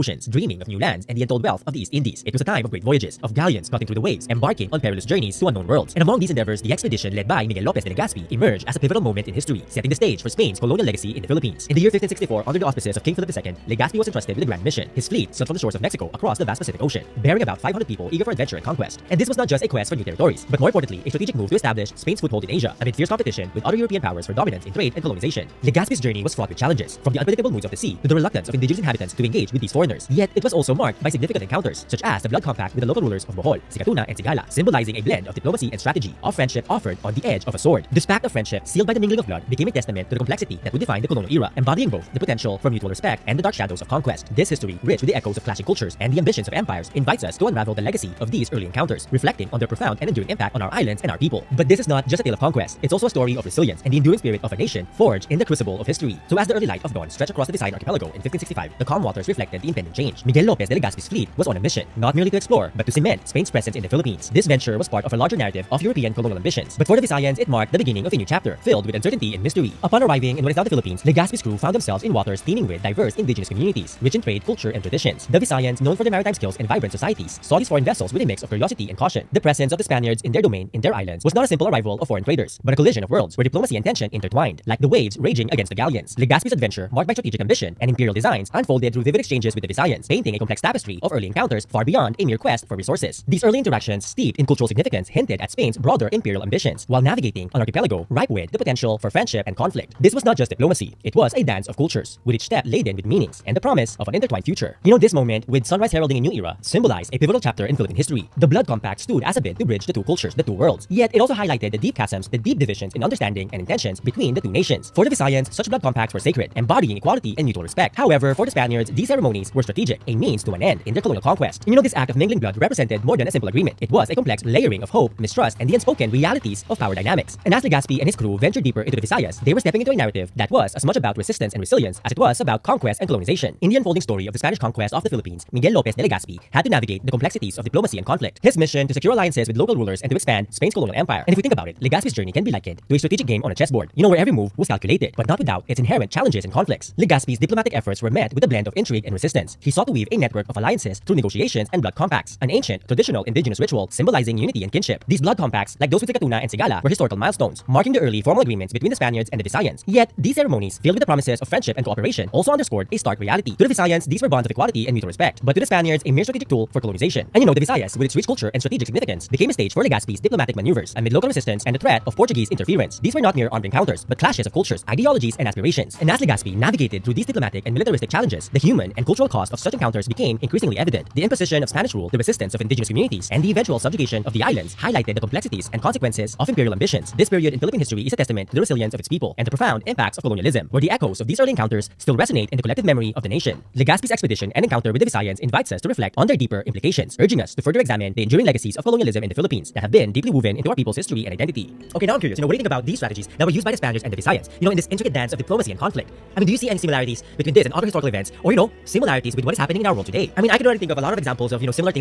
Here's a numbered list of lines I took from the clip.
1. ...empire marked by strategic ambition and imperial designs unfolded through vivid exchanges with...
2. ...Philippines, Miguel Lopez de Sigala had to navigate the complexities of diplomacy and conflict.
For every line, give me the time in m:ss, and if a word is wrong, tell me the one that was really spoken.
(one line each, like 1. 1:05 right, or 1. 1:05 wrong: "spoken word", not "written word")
1. 1:26 wrong: "adventure", not "empire"
2. 2:15 wrong: "Legazpi", not "Sigala".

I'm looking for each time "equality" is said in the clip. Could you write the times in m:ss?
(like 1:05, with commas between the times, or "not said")
1:56, 2:44.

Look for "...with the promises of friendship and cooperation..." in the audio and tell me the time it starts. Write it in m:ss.
2:40.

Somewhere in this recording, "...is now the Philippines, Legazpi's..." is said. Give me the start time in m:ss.
1:10.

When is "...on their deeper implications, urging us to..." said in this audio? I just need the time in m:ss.
3:16.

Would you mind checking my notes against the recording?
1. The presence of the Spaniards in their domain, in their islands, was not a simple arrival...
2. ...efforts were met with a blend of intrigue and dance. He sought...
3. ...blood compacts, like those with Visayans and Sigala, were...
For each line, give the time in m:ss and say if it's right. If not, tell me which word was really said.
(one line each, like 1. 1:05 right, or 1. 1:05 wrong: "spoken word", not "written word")
1. 1:19 right
2. 2:27 wrong: "resistance", not "dance"
3. 2:35 wrong: "Sikatuna", not "Visayans".